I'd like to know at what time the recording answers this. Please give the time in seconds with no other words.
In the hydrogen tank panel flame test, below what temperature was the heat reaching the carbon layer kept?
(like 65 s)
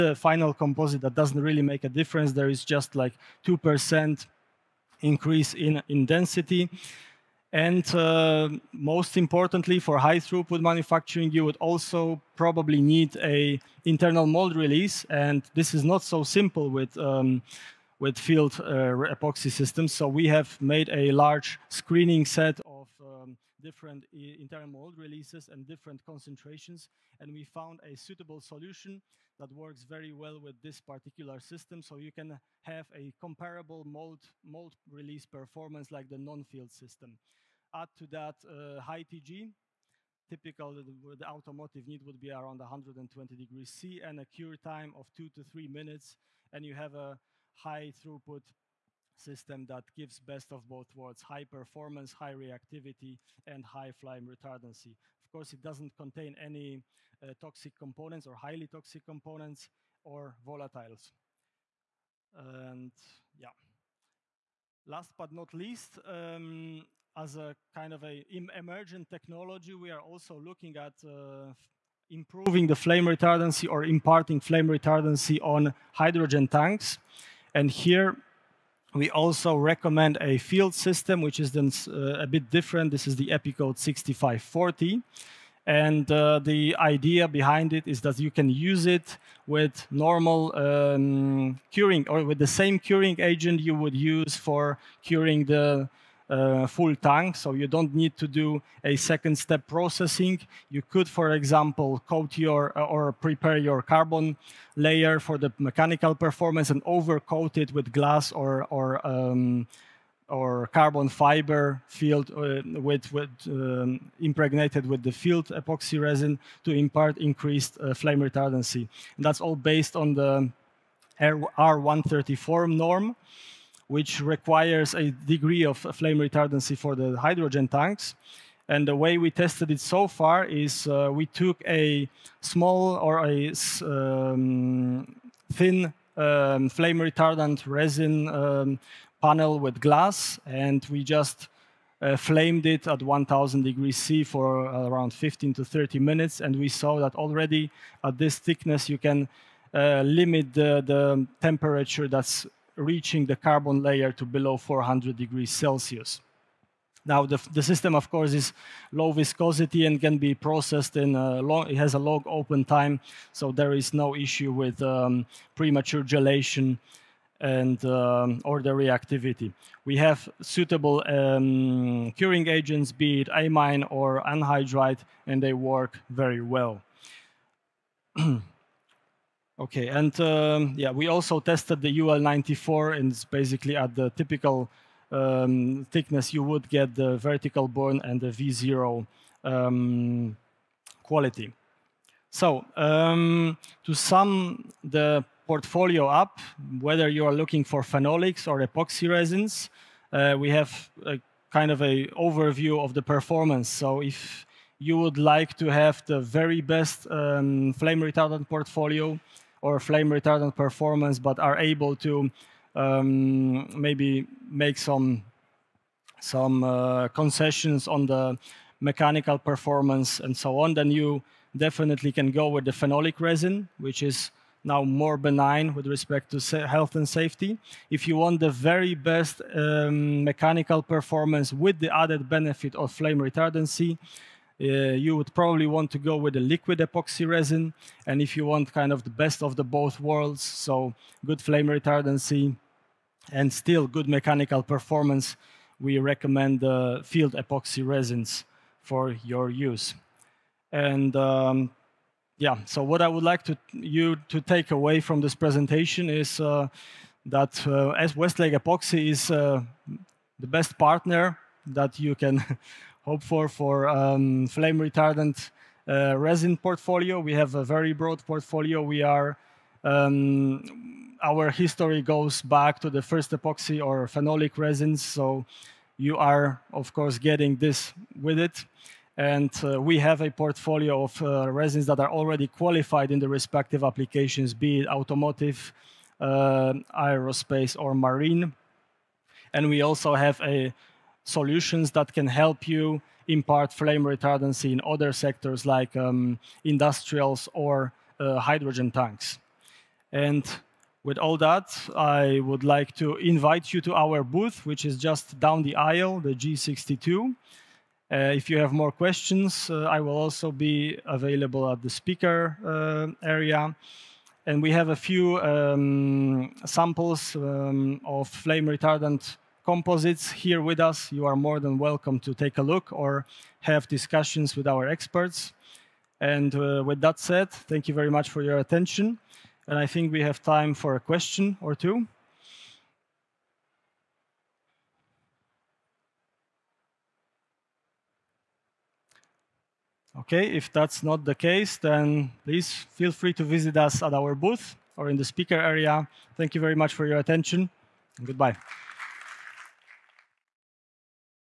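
154 s.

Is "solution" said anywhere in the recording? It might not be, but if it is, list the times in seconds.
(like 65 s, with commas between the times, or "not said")
28 s, 291 s.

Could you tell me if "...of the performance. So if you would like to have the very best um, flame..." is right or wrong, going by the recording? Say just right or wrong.
right.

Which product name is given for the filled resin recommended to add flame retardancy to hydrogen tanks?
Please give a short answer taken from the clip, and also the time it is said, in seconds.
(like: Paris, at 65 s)
Epikote 6540, at 83 s.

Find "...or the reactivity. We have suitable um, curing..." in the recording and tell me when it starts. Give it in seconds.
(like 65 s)
168 s.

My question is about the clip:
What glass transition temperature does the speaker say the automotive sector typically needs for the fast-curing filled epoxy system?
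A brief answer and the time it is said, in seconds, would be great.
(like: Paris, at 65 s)
120 degrees C, at 42 s.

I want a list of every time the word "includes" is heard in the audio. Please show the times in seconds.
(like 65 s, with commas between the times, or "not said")
not said.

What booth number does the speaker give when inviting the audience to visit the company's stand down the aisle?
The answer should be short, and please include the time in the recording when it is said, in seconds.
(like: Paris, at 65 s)
G62, at 306 s.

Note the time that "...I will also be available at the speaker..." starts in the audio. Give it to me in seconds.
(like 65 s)
309 s.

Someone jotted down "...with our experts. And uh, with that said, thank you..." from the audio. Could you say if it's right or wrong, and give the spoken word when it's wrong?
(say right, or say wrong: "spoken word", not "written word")
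right.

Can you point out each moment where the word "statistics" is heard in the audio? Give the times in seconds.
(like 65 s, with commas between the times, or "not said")
not said.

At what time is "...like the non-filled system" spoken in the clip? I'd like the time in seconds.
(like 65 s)
35 s.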